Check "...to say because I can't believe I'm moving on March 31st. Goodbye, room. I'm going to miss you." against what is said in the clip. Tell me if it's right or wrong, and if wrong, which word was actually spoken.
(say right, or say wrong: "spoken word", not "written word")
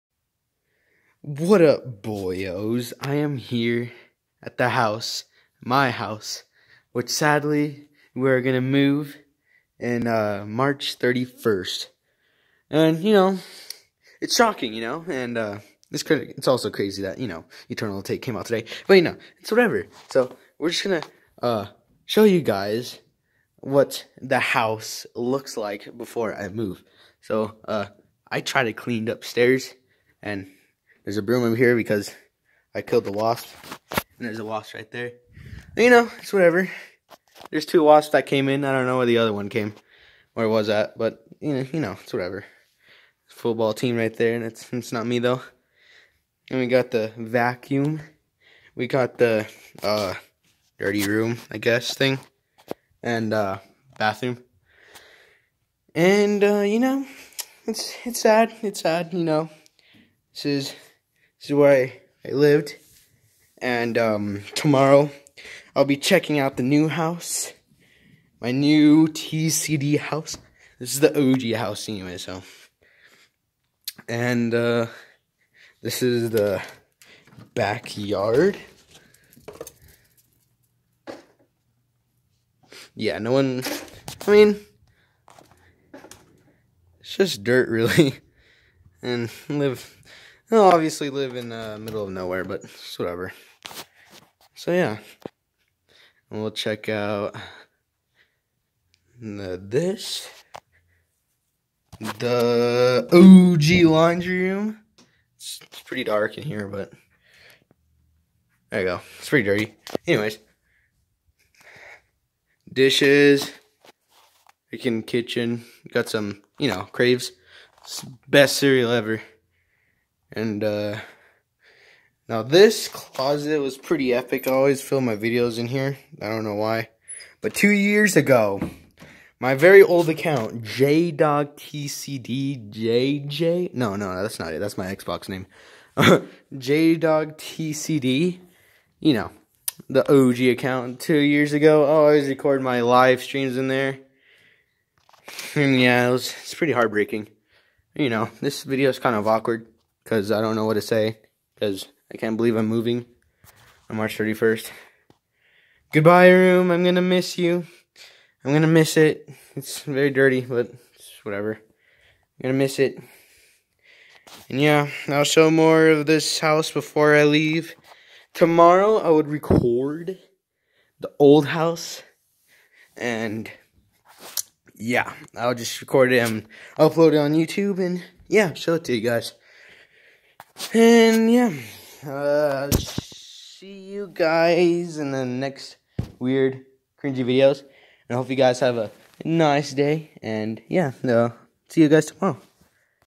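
right.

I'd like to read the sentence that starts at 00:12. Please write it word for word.
And you know, it's shocking, you know, and uh, it's crazy.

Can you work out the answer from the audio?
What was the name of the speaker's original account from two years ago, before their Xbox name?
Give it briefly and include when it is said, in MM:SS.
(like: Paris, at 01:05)
JayDoggTCD, at 02:15.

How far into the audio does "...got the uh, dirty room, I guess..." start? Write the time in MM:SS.
00:48.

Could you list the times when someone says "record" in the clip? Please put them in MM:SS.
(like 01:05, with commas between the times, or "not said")
02:22, 02:49, 02:55.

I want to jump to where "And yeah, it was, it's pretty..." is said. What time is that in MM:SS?
02:25.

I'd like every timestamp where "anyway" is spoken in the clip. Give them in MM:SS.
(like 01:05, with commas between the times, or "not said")
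01:11, 01:50.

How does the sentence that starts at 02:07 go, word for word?
But two years ago, my very old account, JDogTCDJJ.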